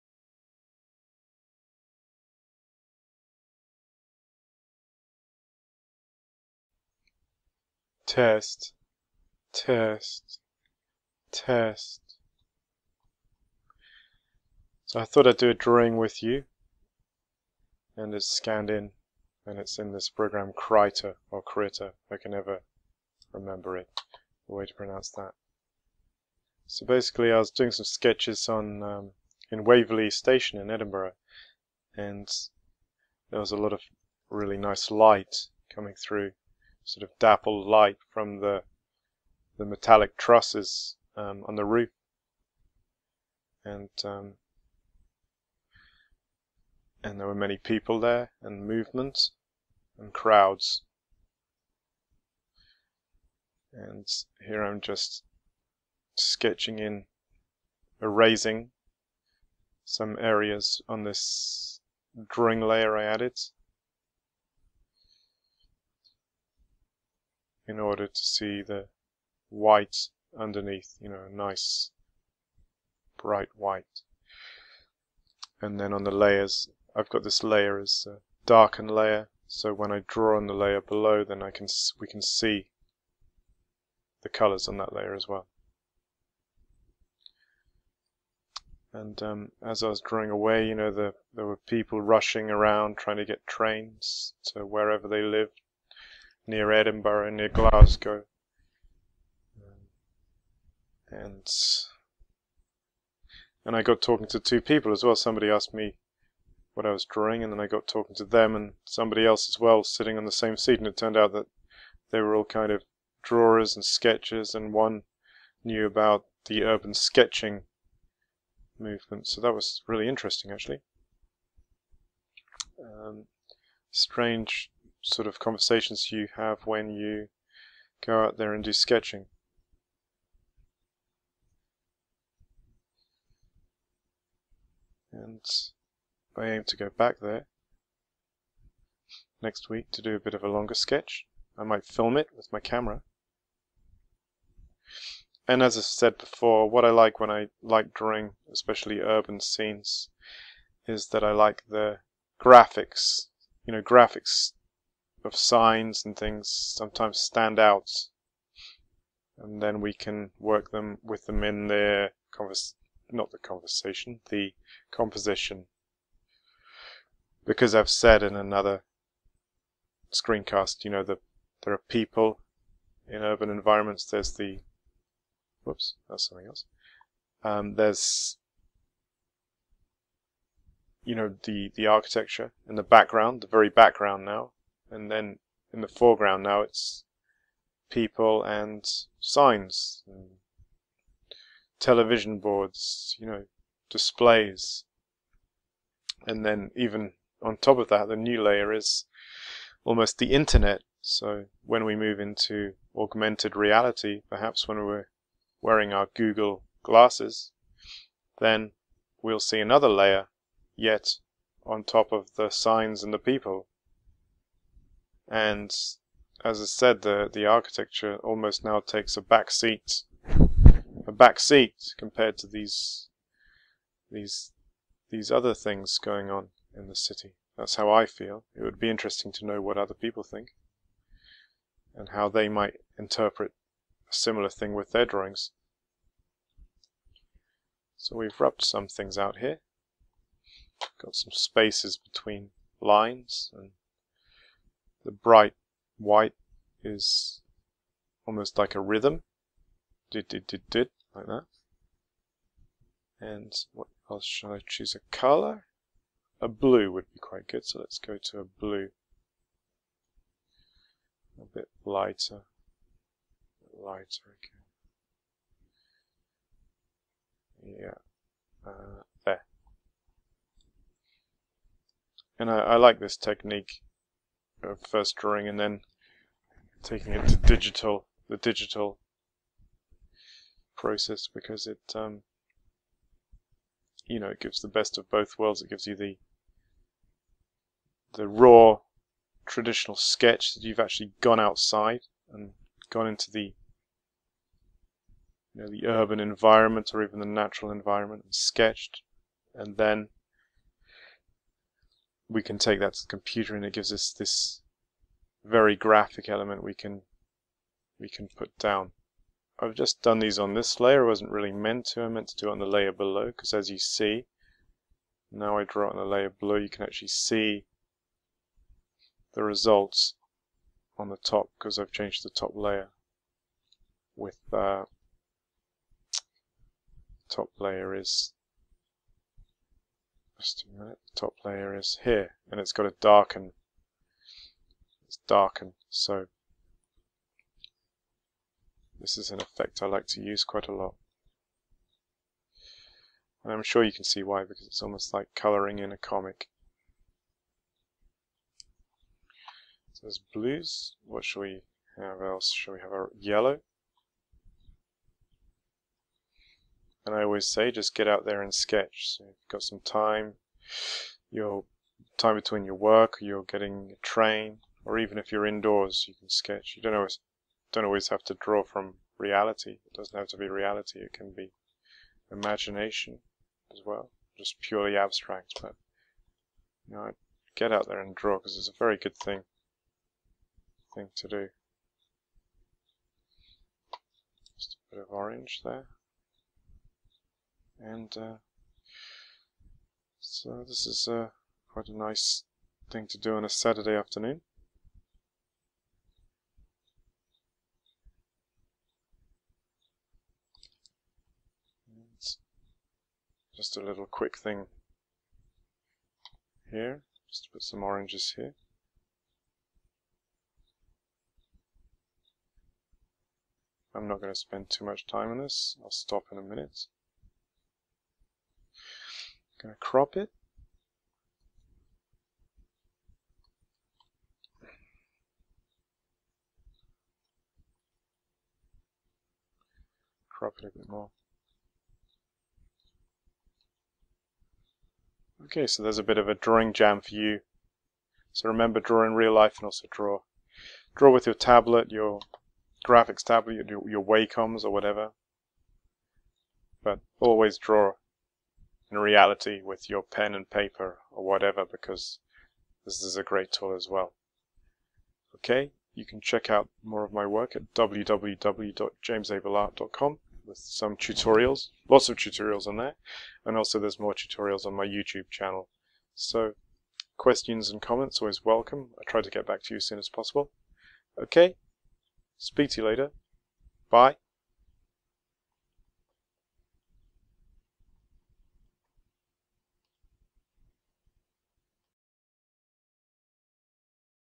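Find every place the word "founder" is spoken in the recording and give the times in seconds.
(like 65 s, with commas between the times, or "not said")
not said.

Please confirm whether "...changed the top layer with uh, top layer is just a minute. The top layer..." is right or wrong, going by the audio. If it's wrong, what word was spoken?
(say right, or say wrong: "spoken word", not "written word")
right.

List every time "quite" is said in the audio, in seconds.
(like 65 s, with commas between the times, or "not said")
257 s, 340 s, 391 s.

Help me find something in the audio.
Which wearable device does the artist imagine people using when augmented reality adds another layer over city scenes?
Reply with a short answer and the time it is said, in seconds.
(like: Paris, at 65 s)
Google glasses, at 206 s.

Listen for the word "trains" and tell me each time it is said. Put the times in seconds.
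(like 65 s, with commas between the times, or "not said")
93 s, 364 s.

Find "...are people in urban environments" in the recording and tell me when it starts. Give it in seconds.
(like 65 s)
171 s.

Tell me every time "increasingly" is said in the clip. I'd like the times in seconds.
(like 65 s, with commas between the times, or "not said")
not said.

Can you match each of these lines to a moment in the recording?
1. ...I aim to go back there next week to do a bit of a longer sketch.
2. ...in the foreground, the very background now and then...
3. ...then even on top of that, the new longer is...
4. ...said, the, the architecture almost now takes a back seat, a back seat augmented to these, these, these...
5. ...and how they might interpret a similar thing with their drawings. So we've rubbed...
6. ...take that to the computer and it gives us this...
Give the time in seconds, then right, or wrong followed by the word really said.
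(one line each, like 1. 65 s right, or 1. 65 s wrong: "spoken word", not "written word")
1. 136 s right
2. 182 s wrong: "background", not "foreground"
3. 196 s wrong: "layer", not "longer"
4. 216 s wrong: "compared", not "augmented"
5. 231 s right
6. 302 s right.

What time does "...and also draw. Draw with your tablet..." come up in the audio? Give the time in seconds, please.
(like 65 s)
439 s.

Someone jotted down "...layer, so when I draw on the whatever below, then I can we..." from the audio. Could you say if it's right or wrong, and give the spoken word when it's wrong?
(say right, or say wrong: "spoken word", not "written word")
wrong: "layer", not "whatever".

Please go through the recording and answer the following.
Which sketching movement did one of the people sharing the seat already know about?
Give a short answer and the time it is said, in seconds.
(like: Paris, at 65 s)
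Urban sketching, at 116 s.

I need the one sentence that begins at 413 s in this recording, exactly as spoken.
I'm not going to spend too much time on this, I'll stop in a minute going to crop it.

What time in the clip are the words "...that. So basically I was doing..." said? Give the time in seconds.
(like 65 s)
25 s.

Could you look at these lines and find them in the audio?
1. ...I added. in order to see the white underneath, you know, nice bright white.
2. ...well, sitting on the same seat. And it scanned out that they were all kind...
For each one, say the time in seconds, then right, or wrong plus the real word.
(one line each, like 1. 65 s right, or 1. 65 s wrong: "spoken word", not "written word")
1. 62 s right
2. 109 s wrong: "turned", not "scanned".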